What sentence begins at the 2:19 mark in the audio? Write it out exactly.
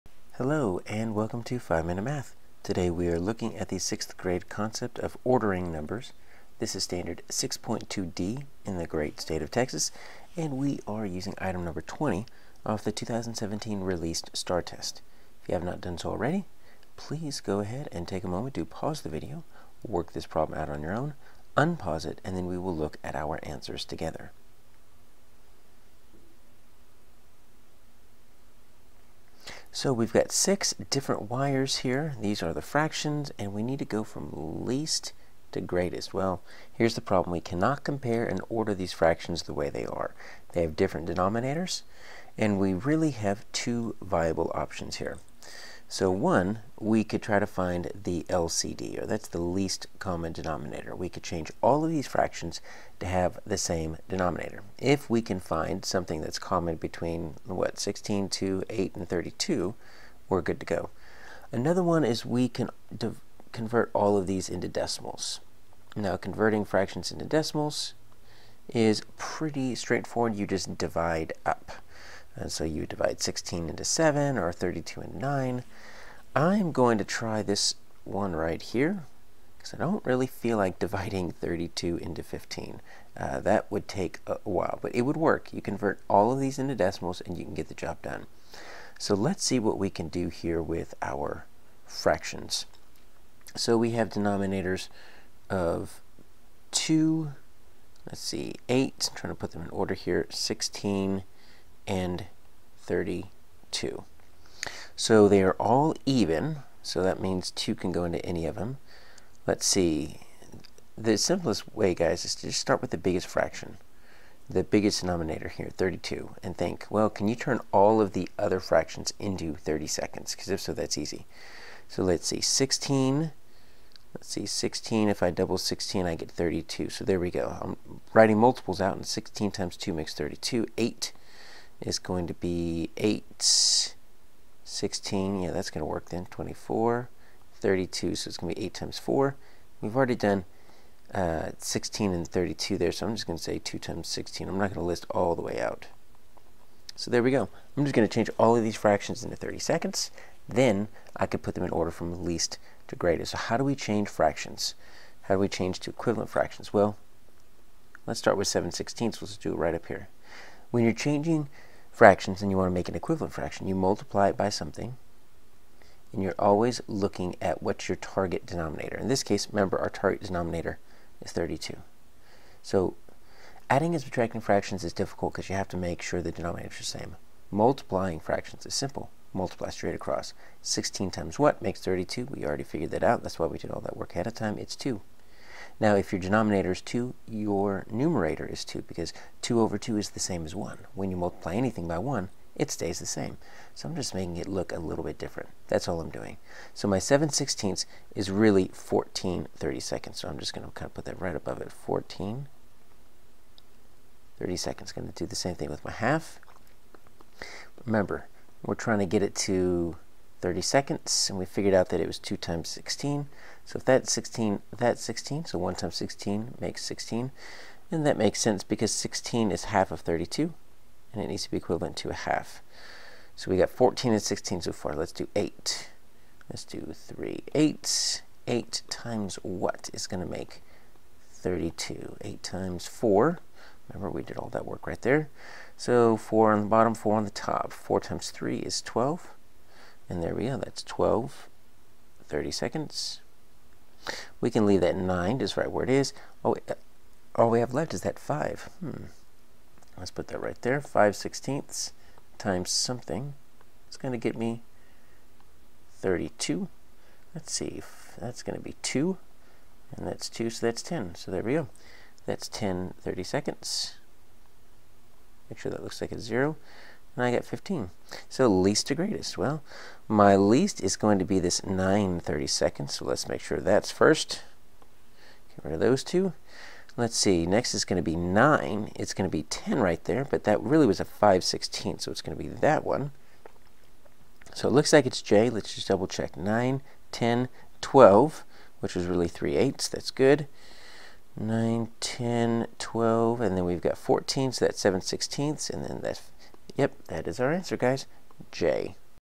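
We've already done uh, 16 and 32 there, so I'm just going to say 2 times 16.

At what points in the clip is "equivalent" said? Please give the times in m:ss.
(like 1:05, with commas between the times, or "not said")
2:35, 2:42, 3:41.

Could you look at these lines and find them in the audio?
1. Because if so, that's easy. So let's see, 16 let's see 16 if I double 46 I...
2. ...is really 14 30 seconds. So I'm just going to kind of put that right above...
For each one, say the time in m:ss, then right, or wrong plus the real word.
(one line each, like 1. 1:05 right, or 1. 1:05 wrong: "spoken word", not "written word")
1. 2:00 wrong: "16", not "46"
2. 3:18 right.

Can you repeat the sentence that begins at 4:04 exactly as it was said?
We can leave that 9 just right where it is.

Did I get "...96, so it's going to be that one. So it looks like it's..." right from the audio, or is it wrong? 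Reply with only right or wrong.
wrong.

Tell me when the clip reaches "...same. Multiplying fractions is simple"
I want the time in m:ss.
2:56.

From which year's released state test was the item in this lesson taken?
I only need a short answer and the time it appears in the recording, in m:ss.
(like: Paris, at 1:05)
2017, at 0:12.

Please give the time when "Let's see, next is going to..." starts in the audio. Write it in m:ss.
4:36.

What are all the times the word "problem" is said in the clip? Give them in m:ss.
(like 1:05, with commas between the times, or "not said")
0:20, 0:37.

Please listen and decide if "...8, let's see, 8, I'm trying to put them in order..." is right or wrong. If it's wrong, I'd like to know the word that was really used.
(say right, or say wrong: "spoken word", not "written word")
wrong: "2", not "8".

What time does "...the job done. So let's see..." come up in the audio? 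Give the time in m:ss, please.
1:27.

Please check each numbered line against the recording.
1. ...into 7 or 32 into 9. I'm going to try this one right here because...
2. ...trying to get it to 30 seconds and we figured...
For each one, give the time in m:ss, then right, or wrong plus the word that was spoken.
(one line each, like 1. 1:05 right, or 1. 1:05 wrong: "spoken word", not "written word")
1. 1:13 right
2. 3:28 right.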